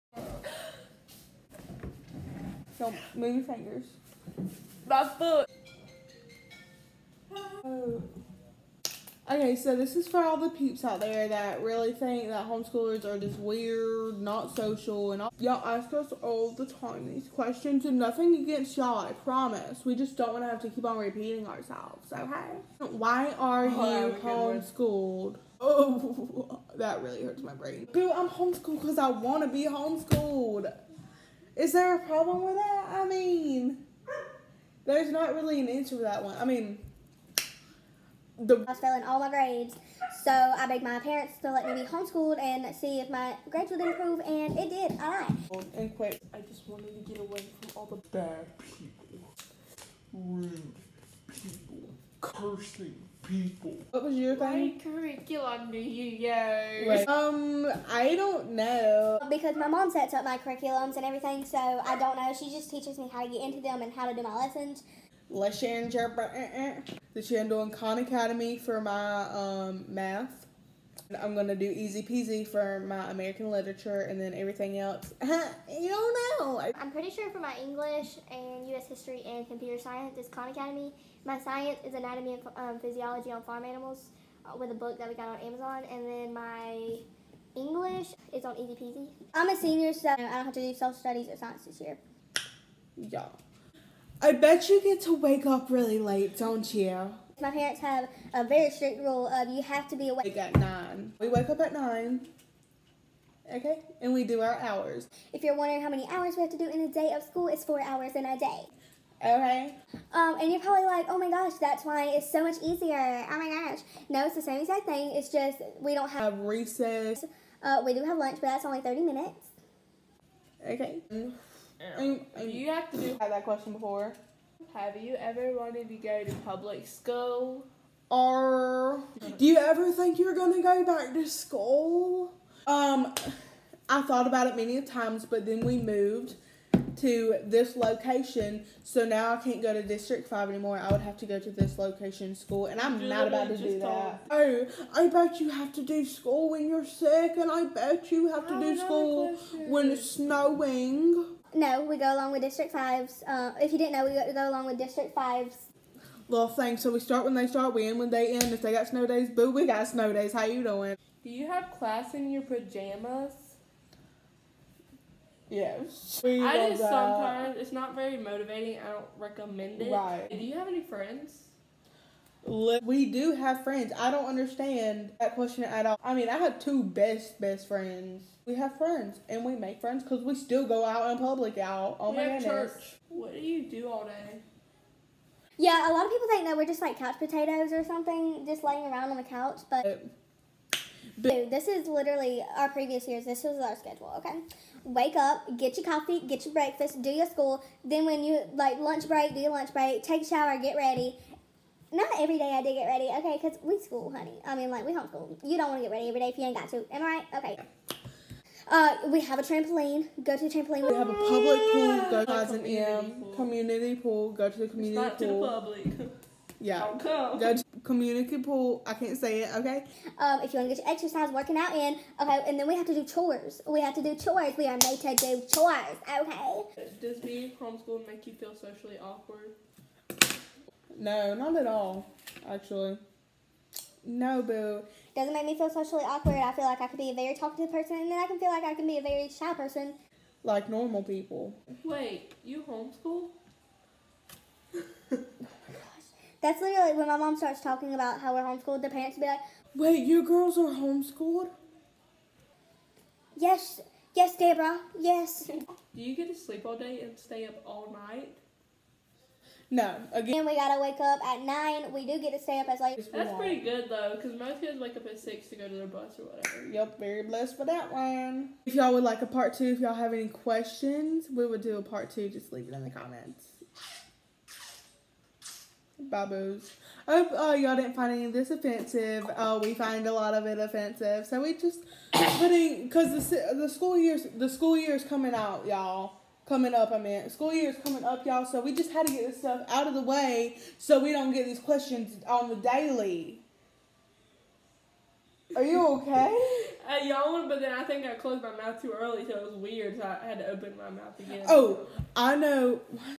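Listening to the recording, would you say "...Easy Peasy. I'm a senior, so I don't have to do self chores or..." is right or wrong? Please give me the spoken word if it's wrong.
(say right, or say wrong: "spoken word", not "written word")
wrong: "studies", not "chores".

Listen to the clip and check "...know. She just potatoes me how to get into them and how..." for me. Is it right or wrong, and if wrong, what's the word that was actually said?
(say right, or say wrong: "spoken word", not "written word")
wrong: "teaches", not "potatoes".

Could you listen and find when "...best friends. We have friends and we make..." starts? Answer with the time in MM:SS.
02:57.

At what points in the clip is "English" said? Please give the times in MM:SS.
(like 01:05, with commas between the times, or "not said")
01:17, 01:27.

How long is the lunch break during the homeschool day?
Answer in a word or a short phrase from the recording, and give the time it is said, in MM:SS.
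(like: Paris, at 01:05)
30 minutes, at 01:58.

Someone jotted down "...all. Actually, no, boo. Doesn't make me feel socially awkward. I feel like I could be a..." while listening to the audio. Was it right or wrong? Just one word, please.
right.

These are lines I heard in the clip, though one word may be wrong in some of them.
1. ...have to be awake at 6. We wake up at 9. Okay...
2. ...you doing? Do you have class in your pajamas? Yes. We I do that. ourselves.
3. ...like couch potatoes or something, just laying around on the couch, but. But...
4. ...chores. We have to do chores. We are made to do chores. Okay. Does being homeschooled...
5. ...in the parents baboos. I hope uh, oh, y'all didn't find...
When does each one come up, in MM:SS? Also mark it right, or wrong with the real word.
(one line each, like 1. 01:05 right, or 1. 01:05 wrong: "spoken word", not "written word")
1. 01:39 wrong: "9", not "6"
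2. 02:40 wrong: "sometimes", not "ourselves"
3. 03:06 right
4. 03:43 right
5. 04:32 wrong: "comments", not "parents".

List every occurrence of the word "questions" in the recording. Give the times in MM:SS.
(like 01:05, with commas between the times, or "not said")
00:17, 02:03, 02:55, 04:30, 04:51.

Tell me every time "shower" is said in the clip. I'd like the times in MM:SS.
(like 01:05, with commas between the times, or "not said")
03:20.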